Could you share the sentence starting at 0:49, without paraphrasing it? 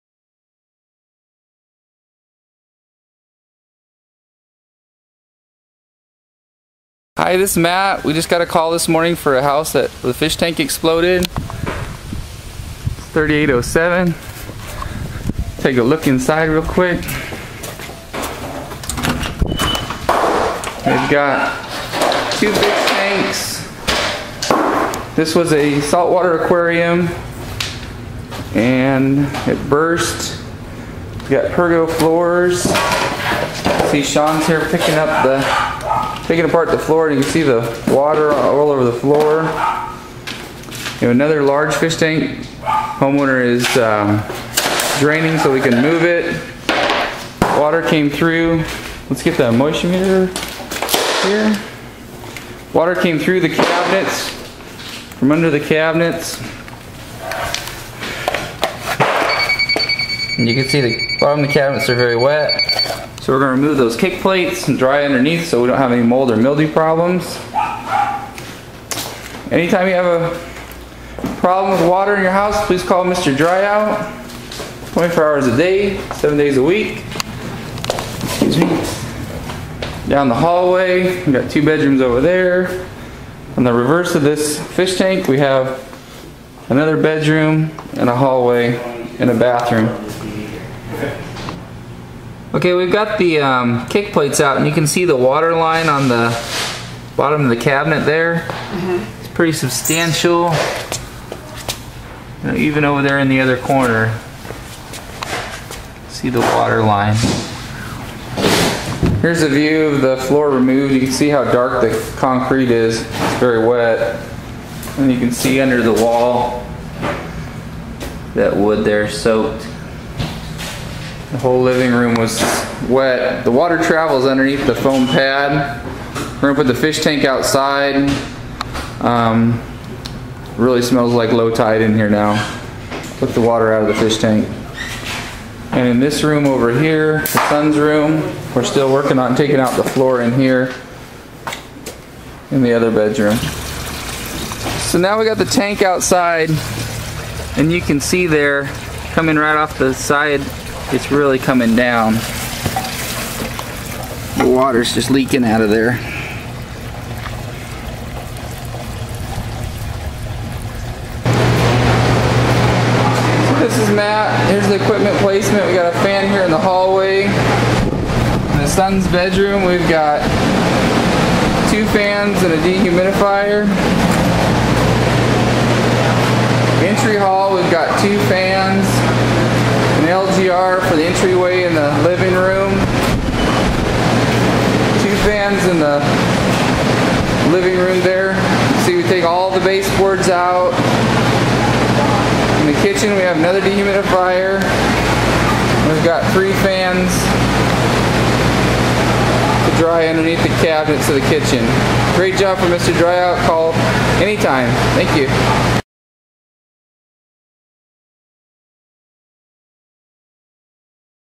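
Let's get the moisture meter here.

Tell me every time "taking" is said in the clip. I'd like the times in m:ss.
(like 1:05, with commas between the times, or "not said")
0:36, 2:19.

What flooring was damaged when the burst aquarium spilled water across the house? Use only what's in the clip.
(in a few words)
Pergo.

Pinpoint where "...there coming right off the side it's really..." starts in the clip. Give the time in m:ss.
2:28.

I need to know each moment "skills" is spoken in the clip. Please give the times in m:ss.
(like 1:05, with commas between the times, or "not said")
not said.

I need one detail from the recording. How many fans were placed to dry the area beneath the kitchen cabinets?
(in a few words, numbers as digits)
3.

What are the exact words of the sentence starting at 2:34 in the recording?
The water's just leaking out of there.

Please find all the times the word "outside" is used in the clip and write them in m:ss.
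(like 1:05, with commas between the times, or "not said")
2:07, 2:25.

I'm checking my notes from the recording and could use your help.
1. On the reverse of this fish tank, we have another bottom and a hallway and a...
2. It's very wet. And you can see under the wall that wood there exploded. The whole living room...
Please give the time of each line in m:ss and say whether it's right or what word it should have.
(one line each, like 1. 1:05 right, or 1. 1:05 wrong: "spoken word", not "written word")
1. 1:23 wrong: "bedroom", not "bottom"
2. 1:52 wrong: "soaked", not "exploded".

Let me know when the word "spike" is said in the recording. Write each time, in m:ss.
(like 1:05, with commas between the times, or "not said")
not said.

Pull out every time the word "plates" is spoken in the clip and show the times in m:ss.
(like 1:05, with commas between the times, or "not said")
1:04, 1:34.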